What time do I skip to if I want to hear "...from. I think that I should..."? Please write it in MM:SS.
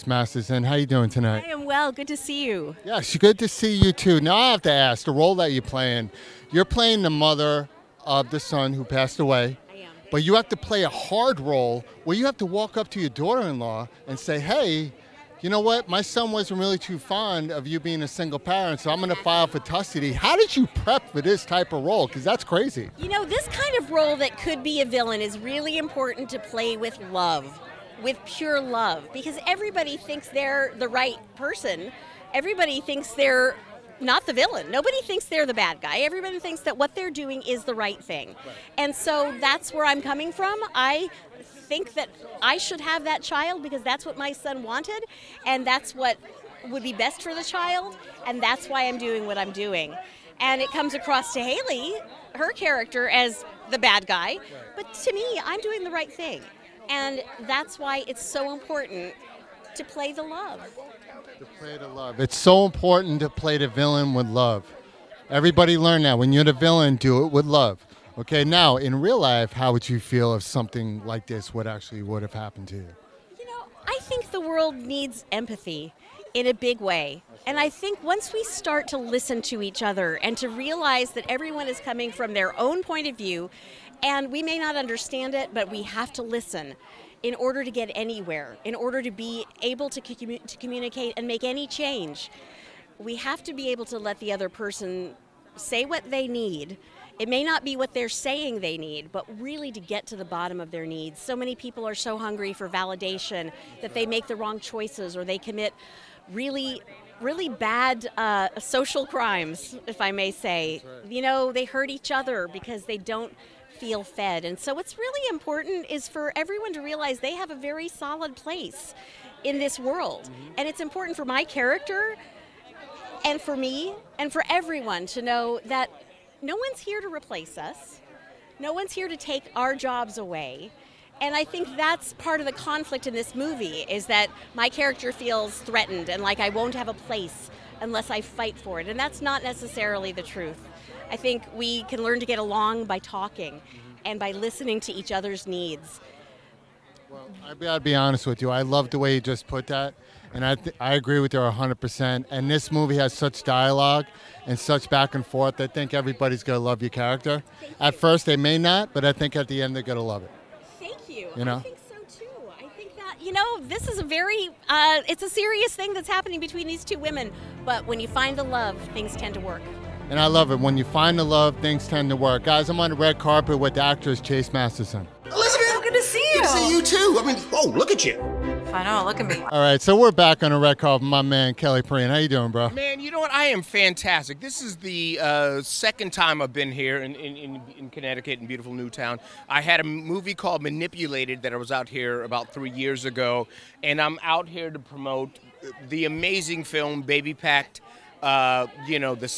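00:40.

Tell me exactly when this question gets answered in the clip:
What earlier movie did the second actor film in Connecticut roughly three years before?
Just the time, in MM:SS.
03:10.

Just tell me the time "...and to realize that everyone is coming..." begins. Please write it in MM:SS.
01:20.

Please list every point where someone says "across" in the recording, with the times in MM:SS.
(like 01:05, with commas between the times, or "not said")
00:50.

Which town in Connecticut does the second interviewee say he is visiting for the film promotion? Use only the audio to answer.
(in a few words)
Newtown.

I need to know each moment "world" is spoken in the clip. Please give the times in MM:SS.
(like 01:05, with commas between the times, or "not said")
01:14, 01:59.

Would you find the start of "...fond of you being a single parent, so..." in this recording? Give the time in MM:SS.
00:16.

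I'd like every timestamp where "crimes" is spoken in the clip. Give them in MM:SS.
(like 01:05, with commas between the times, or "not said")
01:49.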